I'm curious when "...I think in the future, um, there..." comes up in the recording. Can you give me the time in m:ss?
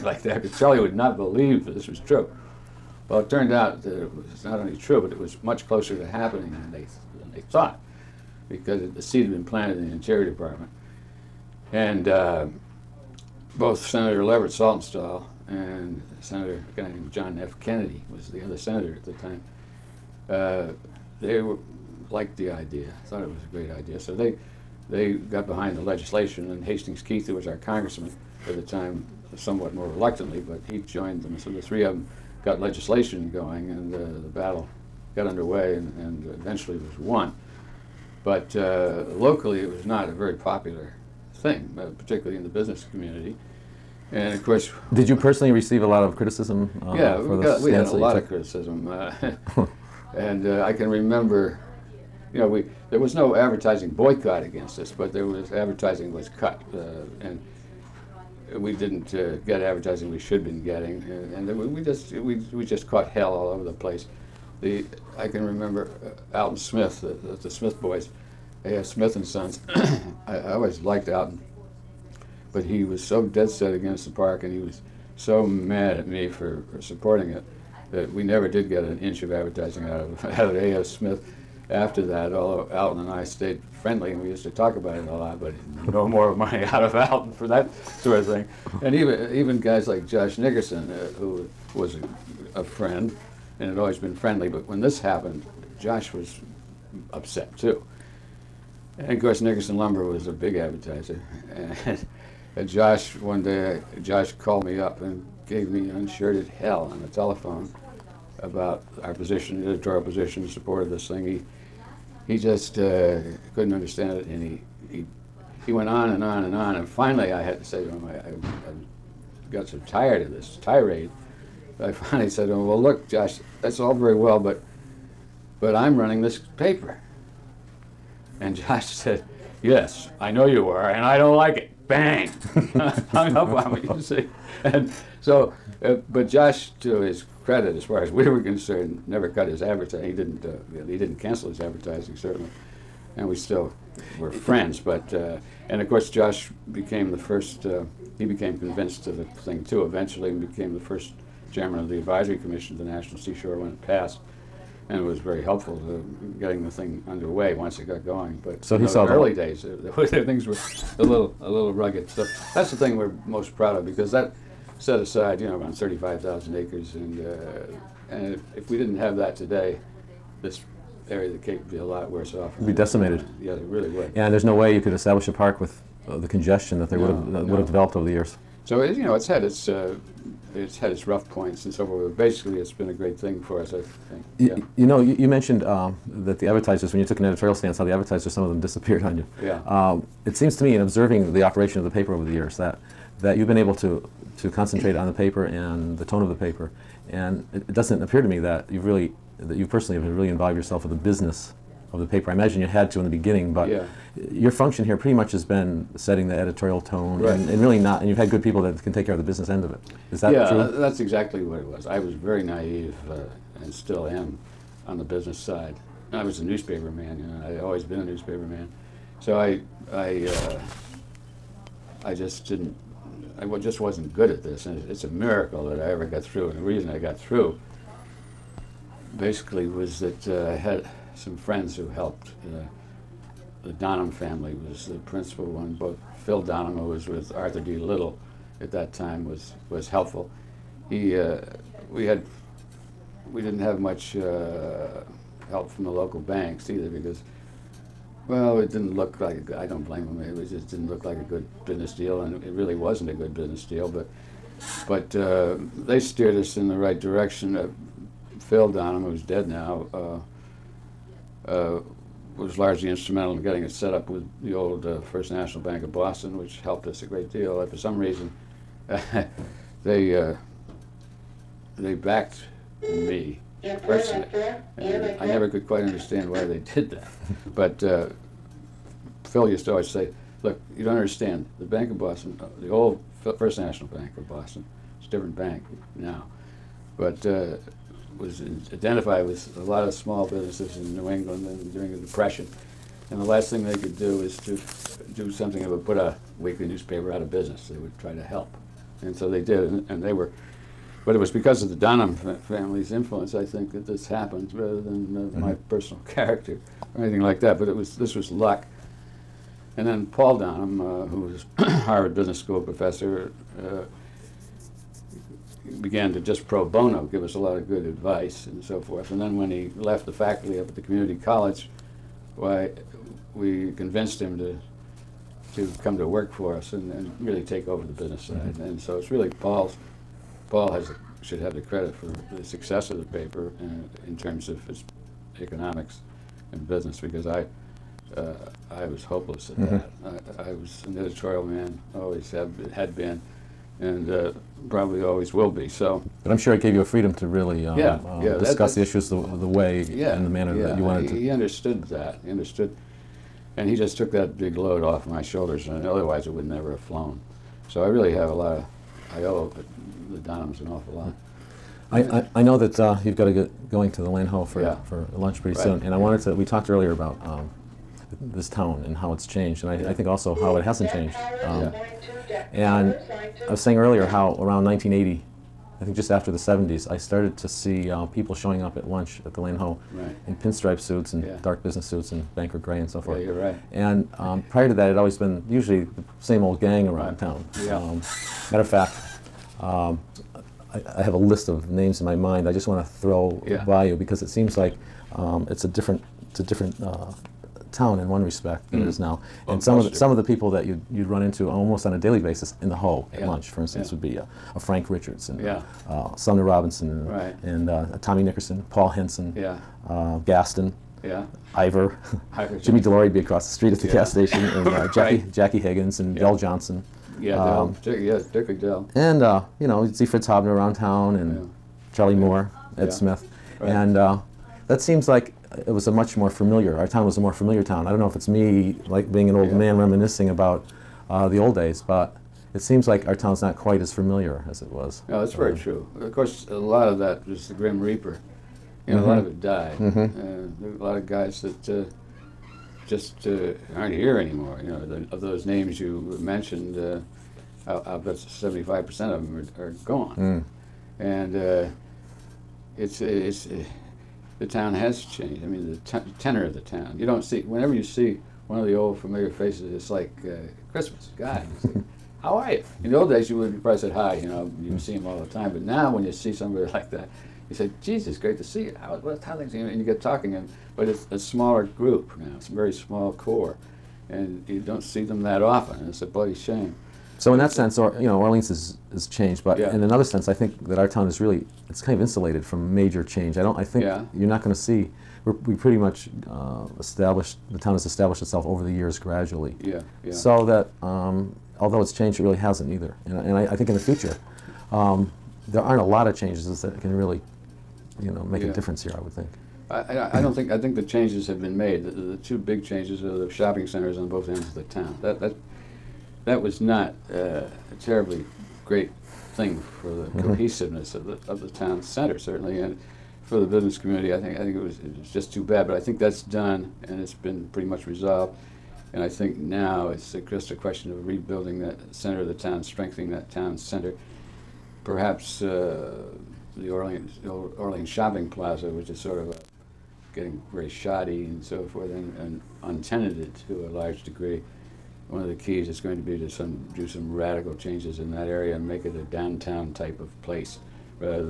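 8:13.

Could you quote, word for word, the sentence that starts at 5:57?
So I really have a lot of, I owe the Donhams an awful lot.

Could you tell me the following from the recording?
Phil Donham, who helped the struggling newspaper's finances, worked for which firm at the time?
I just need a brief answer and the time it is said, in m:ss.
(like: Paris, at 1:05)
Arthur D. Little, at 3:57.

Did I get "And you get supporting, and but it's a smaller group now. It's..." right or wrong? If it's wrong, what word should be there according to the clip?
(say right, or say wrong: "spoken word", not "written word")
wrong: "talking", not "supporting".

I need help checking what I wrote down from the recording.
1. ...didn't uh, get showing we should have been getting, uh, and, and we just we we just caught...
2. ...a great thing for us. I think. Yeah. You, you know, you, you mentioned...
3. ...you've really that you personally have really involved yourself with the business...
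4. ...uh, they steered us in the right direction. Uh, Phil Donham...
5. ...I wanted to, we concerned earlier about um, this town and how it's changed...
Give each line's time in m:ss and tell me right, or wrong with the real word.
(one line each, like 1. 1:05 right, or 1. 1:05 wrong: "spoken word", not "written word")
1. 0:58 wrong: "advertising", not "showing"
2. 3:02 right
3. 3:18 right
4. 4:15 right
5. 6:05 wrong: "talked", not "concerned".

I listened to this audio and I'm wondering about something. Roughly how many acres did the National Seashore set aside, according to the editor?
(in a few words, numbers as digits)
35,000 acres.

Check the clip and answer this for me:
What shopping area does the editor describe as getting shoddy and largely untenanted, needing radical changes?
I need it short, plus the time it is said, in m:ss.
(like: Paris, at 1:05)
Orleans Shopping Plaza, at 8:47.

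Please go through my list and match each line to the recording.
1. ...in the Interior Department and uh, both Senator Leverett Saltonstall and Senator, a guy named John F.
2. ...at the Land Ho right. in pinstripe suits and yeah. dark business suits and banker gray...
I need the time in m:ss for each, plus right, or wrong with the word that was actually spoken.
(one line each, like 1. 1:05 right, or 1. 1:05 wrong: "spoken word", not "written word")
1. 0:09 right
2. 6:19 right.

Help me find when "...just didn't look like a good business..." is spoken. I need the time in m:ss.
4:10.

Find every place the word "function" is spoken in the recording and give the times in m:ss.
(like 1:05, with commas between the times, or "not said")
3:24.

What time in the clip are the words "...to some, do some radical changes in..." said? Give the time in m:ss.
8:56.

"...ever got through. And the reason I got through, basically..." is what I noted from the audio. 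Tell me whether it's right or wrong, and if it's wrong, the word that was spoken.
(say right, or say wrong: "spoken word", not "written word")
right.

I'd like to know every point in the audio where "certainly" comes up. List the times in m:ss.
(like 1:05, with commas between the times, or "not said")
2:22, 8:32.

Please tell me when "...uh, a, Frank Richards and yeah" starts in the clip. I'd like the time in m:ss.
6:44.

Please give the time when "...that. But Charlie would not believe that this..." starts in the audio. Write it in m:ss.
0:00.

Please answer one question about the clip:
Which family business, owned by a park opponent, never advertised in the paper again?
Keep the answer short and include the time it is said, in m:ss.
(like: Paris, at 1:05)
A.F. Smith and Sons, at 1:08.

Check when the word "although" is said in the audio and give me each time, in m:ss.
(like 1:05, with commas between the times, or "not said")
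1:22, 8:11.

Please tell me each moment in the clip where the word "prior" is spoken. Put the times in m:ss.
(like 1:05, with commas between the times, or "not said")
6:24.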